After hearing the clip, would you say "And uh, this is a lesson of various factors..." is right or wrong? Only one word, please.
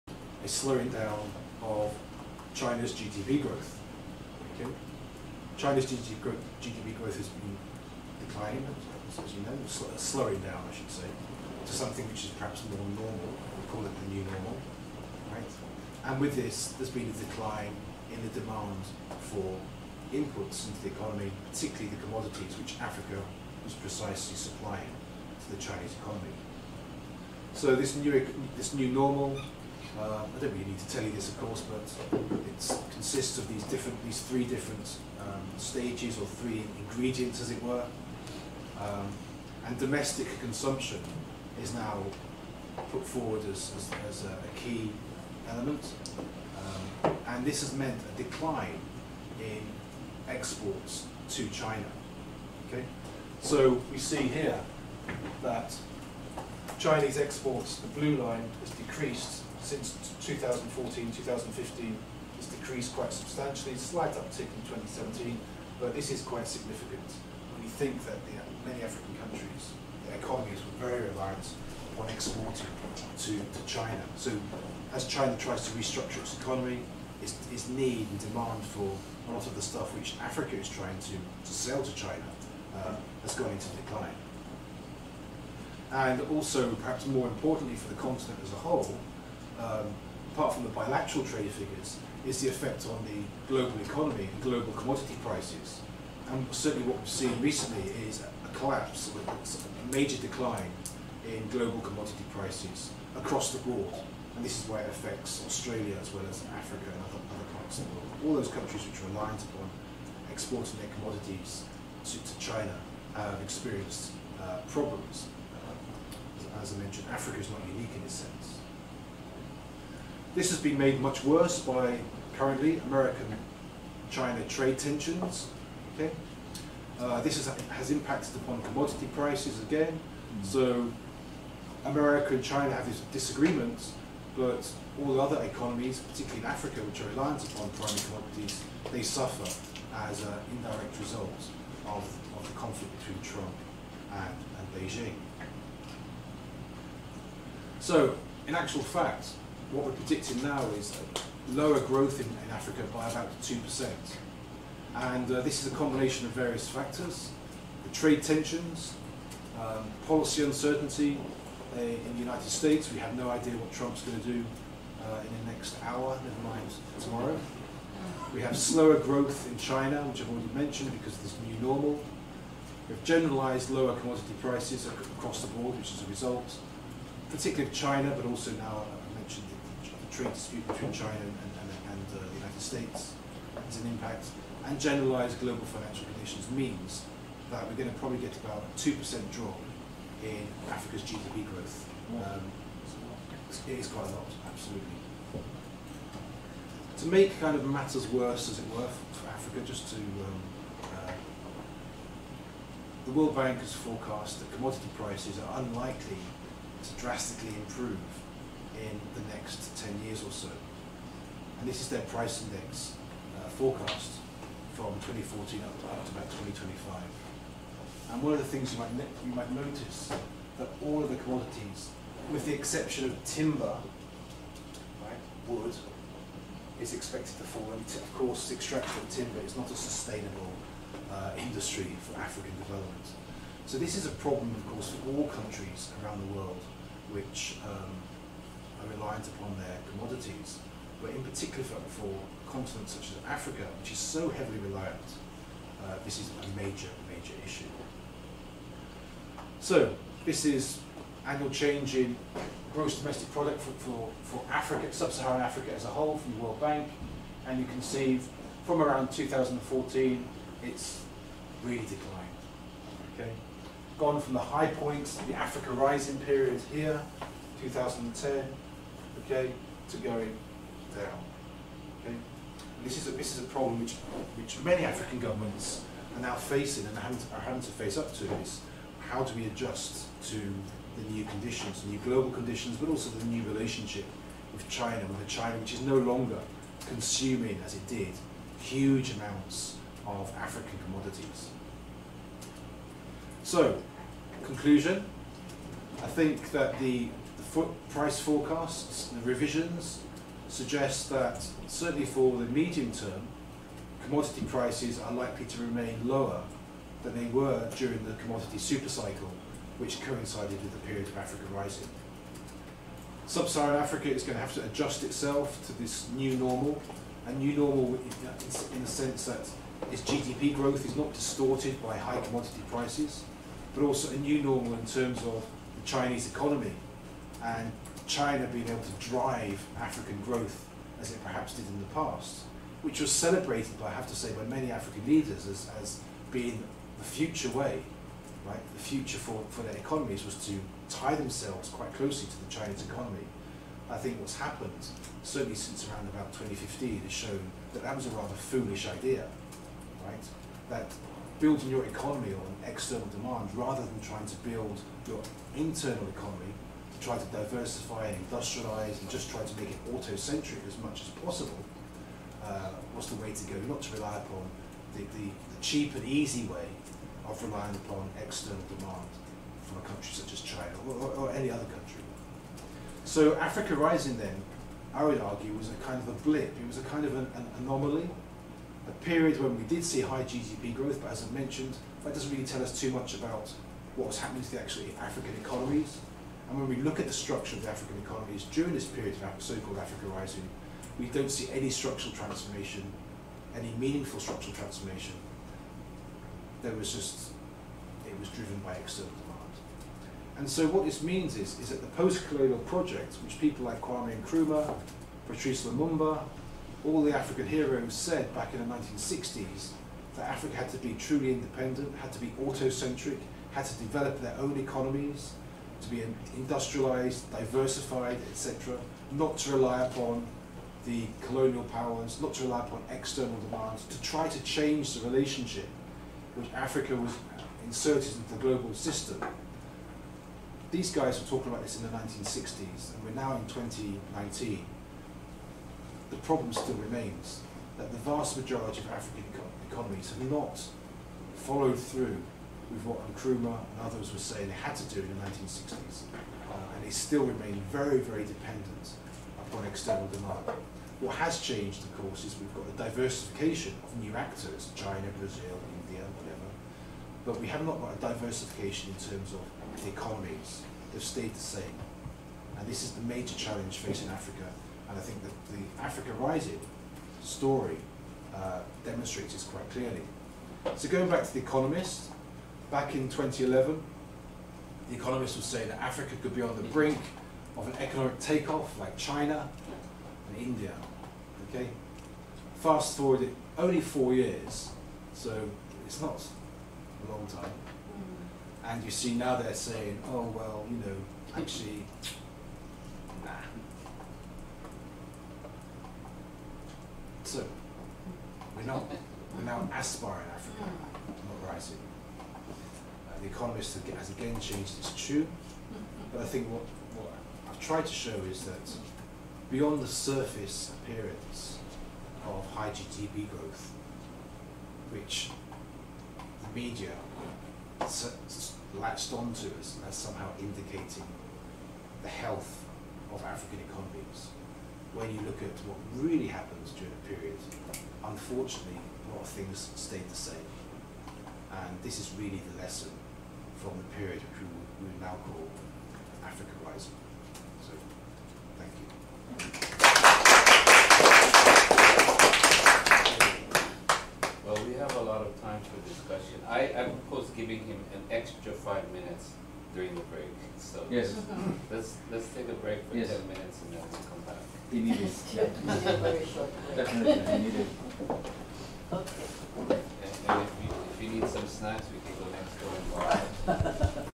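wrong.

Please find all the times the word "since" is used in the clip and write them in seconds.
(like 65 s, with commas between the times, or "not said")
59 s, 345 s.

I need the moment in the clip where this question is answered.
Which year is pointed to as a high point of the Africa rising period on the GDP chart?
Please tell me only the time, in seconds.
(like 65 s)
267 s.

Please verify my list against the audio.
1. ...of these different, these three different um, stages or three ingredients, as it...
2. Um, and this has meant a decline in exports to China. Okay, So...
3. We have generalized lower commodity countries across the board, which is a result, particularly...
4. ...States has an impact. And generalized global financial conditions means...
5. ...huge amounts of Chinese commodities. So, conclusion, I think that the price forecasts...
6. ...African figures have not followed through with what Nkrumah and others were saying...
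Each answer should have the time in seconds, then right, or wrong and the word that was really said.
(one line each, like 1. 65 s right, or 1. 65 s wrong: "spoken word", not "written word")
1. 33 s right
2. 47 s right
3. 172 s wrong: "prices", not "countries"
4. 182 s right
5. 288 s wrong: "African", not "Chinese"
6. 438 s wrong: "economies", not "figures".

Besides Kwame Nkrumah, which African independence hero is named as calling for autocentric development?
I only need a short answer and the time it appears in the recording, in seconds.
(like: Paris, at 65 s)
Patrice Lumumba, at 405 s.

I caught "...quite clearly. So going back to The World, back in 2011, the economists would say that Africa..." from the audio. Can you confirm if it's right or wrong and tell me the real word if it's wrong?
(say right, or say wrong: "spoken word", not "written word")
wrong: "Economist", not "World".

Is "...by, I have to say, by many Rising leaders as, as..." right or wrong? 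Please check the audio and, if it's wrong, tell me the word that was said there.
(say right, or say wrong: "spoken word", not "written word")
wrong: "African", not "Rising".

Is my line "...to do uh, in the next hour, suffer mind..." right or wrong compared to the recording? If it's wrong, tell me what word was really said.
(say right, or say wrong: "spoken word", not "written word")
wrong: "never", not "suffer".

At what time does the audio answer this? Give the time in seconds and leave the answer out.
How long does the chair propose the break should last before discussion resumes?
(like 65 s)
553 s.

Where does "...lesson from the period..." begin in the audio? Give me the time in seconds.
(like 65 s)
532 s.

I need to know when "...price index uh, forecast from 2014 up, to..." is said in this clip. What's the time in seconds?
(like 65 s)
212 s.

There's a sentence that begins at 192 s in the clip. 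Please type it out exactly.
Um, it is quite a lot, absolutely.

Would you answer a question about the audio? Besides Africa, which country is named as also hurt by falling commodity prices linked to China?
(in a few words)
Australia.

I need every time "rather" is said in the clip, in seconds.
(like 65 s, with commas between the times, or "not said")
348 s, 353 s.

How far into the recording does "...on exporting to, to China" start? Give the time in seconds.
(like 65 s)
71 s.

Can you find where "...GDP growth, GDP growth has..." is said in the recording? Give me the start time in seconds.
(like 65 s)
5 s.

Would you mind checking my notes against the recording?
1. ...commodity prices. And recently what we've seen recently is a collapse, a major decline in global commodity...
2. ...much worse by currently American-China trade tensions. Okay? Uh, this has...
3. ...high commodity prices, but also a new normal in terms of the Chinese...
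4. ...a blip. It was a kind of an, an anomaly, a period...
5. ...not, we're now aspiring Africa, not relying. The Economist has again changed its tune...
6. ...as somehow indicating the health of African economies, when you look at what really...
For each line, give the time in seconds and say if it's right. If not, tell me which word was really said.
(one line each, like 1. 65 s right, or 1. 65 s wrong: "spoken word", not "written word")
1. 94 s wrong: "certainly", not "recently"
2. 121 s right
3. 321 s right
4. 376 s right
5. 498 s wrong: "rising", not "relying"
6. 519 s right.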